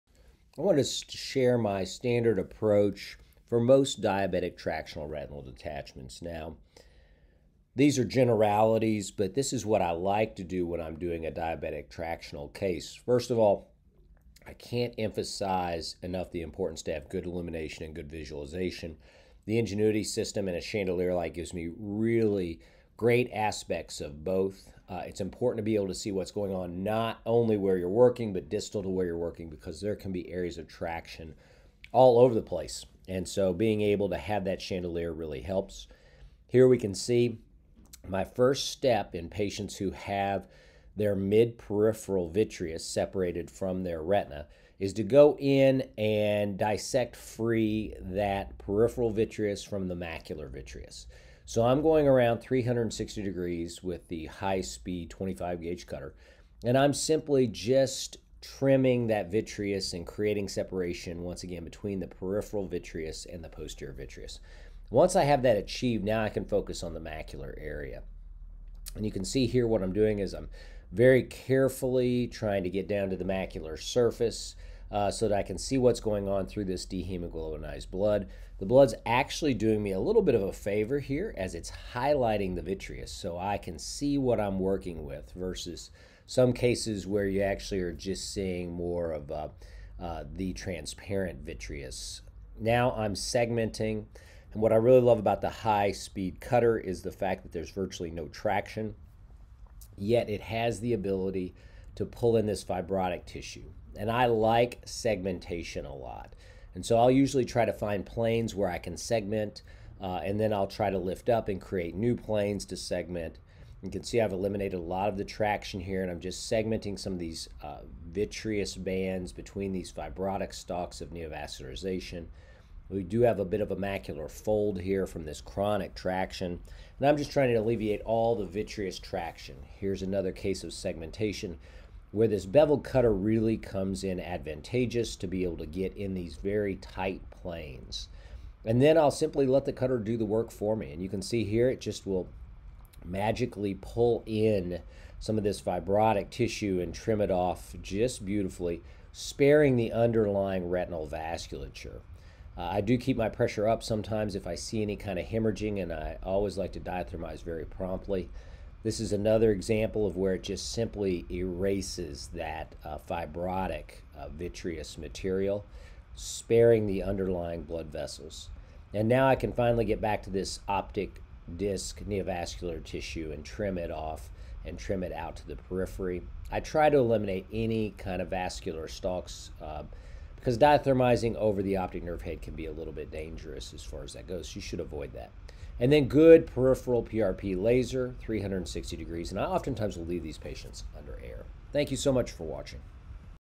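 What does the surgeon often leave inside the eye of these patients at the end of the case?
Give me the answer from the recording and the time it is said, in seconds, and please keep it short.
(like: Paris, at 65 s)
air, at 191 s.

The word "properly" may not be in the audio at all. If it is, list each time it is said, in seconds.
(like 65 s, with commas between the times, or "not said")
not said.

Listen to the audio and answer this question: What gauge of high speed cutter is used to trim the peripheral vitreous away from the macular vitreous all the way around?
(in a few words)
25 gauge.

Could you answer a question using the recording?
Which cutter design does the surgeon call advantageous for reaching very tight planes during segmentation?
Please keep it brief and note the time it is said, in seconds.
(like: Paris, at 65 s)
bevel cutter, at 132 s.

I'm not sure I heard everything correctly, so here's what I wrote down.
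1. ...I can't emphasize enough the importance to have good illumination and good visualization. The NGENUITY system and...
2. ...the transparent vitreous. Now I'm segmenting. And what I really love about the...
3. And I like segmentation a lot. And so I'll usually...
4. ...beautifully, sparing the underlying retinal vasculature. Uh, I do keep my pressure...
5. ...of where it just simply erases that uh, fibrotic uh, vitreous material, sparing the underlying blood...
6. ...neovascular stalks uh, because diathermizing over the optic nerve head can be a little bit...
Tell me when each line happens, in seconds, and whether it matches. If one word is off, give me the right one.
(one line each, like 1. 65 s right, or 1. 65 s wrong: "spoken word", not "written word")
1. 14 s right
2. 90 s right
3. 103 s right
4. 148 s right
5. 160 s right
6. 178 s wrong: "vascular", not "neovascular".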